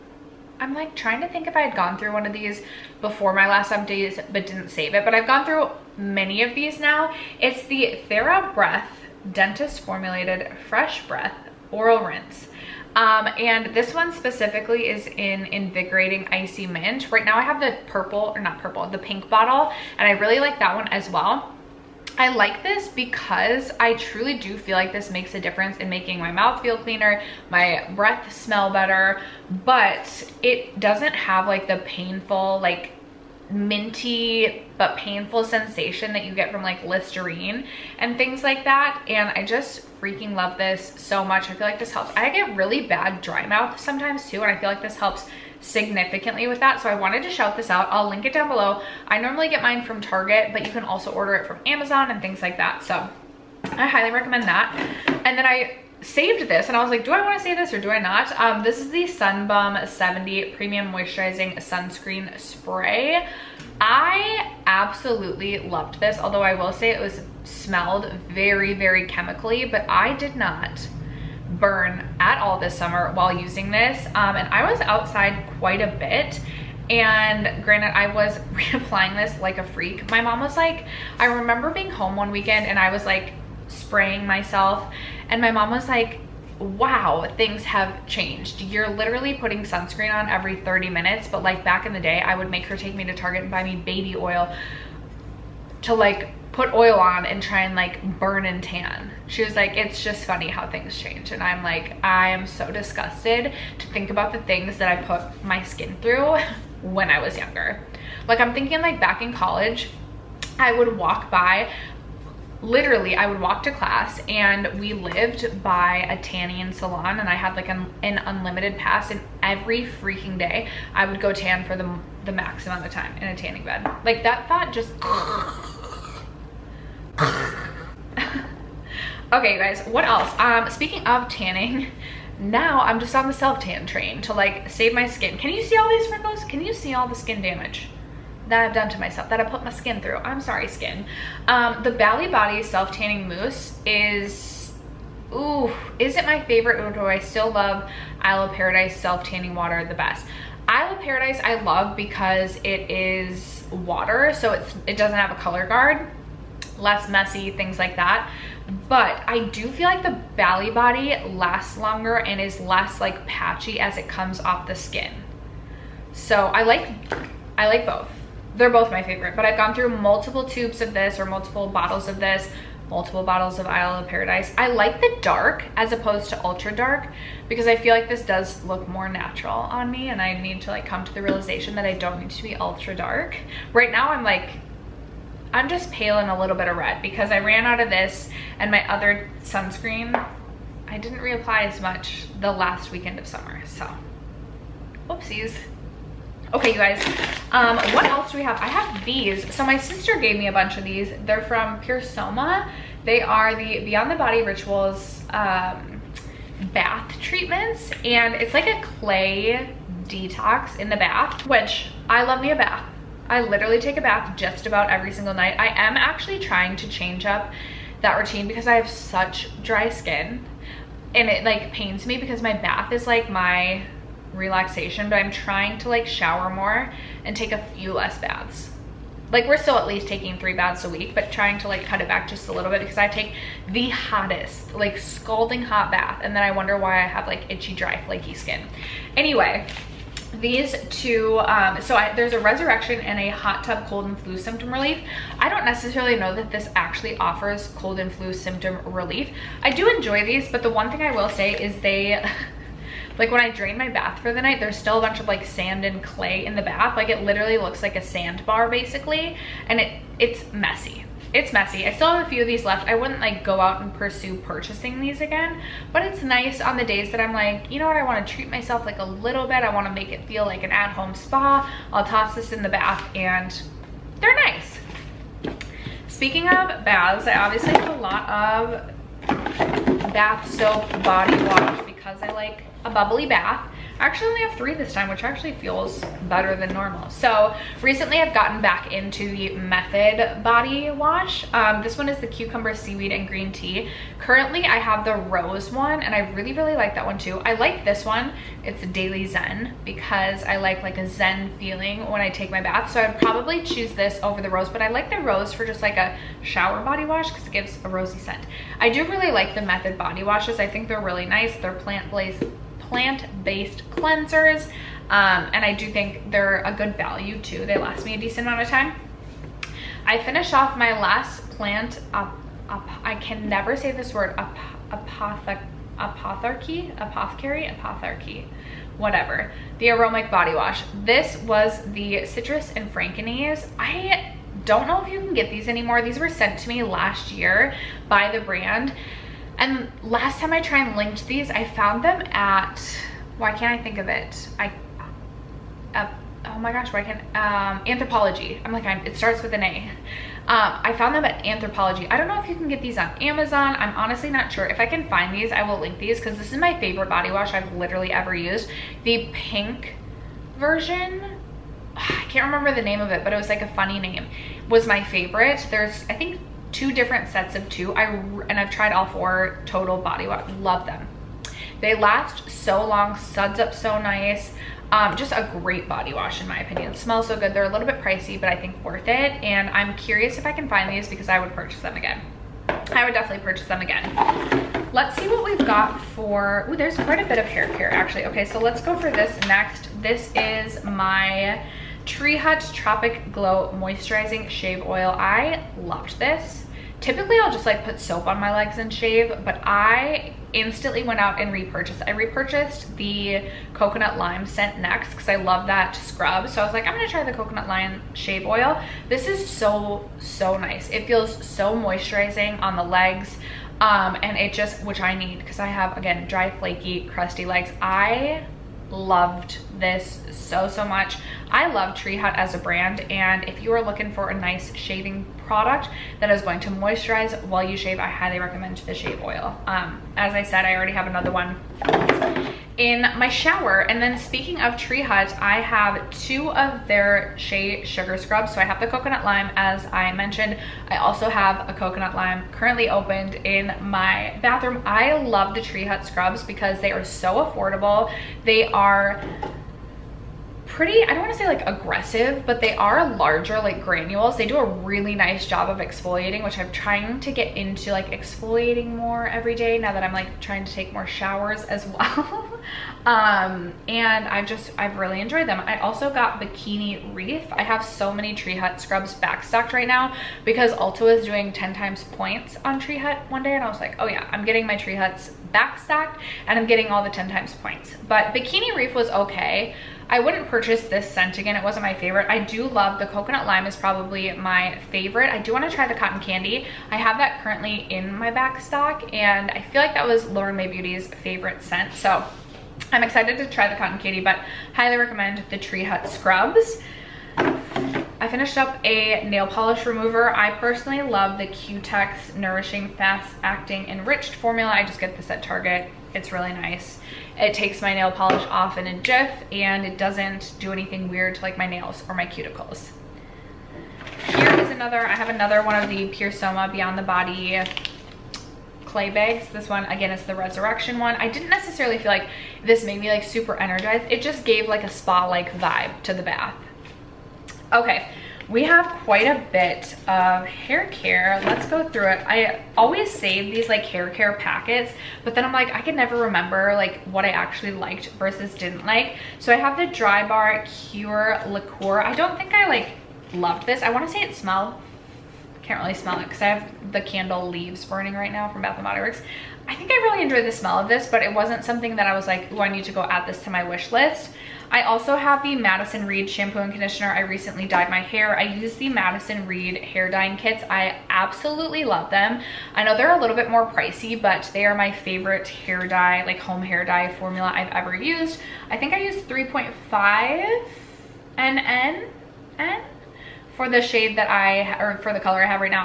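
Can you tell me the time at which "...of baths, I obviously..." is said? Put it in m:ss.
4:36.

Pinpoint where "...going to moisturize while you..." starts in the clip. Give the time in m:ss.
7:06.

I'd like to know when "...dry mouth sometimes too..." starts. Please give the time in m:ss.
0:43.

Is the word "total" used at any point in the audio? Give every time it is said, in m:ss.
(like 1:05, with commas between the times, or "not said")
6:09.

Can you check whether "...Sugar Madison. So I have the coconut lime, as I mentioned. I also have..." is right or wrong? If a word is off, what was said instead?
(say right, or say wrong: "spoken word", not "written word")
wrong: "Scrubs", not "Madison".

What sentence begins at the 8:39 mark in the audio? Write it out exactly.
This one, again, is the Resurrection one.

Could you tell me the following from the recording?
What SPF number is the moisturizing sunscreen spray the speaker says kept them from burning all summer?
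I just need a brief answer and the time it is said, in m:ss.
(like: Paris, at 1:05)
70, at 0:59.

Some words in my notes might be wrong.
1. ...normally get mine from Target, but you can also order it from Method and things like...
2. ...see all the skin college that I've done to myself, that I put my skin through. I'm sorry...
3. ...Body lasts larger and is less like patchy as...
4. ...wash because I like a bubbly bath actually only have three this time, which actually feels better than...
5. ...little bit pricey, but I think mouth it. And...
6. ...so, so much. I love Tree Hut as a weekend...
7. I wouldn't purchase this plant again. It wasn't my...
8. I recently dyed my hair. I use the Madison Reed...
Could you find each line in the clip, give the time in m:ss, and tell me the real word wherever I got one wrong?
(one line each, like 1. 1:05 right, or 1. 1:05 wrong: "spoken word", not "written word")
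1. 0:49 wrong: "Amazon", not "Method"
2. 2:16 wrong: "damage", not "college"
3. 2:40 wrong: "longer", not "larger"
4. 4:41 right
5. 6:17 wrong: "worth", not "mouth"
6. 7:00 wrong: "brand", not "weekend"
7. 8:00 wrong: "scent", not "plant"
8. 9:17 right.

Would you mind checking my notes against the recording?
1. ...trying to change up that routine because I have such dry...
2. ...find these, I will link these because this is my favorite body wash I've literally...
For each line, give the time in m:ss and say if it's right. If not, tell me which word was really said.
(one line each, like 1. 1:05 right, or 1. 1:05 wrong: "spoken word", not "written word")
1. 3:36 right
2. 5:55 right.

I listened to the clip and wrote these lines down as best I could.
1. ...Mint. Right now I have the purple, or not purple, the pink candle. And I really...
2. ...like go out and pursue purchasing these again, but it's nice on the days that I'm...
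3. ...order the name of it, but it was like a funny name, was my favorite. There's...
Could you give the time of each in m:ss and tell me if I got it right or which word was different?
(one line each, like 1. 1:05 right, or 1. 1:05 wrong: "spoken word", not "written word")
1. 0:16 wrong: "bottle", not "candle"
2. 4:23 right
3. 6:02 wrong: "remember", not "order".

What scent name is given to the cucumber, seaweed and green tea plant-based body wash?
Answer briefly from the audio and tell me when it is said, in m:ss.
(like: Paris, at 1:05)
Daily Zen, at 4:58.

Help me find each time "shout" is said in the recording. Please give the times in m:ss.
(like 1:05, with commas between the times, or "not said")
0:47.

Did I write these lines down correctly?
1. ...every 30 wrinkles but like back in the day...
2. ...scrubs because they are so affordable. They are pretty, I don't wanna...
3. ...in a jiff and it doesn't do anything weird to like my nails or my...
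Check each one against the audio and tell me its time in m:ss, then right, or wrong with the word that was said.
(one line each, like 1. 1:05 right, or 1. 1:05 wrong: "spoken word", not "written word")
1. 1:30 wrong: "minutes", not "wrinkles"
2. 7:26 right
3. 8:28 right.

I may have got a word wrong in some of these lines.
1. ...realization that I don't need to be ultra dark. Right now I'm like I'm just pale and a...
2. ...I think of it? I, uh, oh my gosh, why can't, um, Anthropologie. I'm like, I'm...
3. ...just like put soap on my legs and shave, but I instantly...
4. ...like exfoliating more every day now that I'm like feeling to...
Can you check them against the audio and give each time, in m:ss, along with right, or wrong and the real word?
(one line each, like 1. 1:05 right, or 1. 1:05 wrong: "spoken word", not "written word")
1. 3:01 right
2. 5:43 right
3. 6:37 right
4. 7:37 wrong: "trying", not "feeling".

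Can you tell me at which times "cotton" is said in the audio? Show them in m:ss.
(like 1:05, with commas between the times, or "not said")
8:05, 8:13.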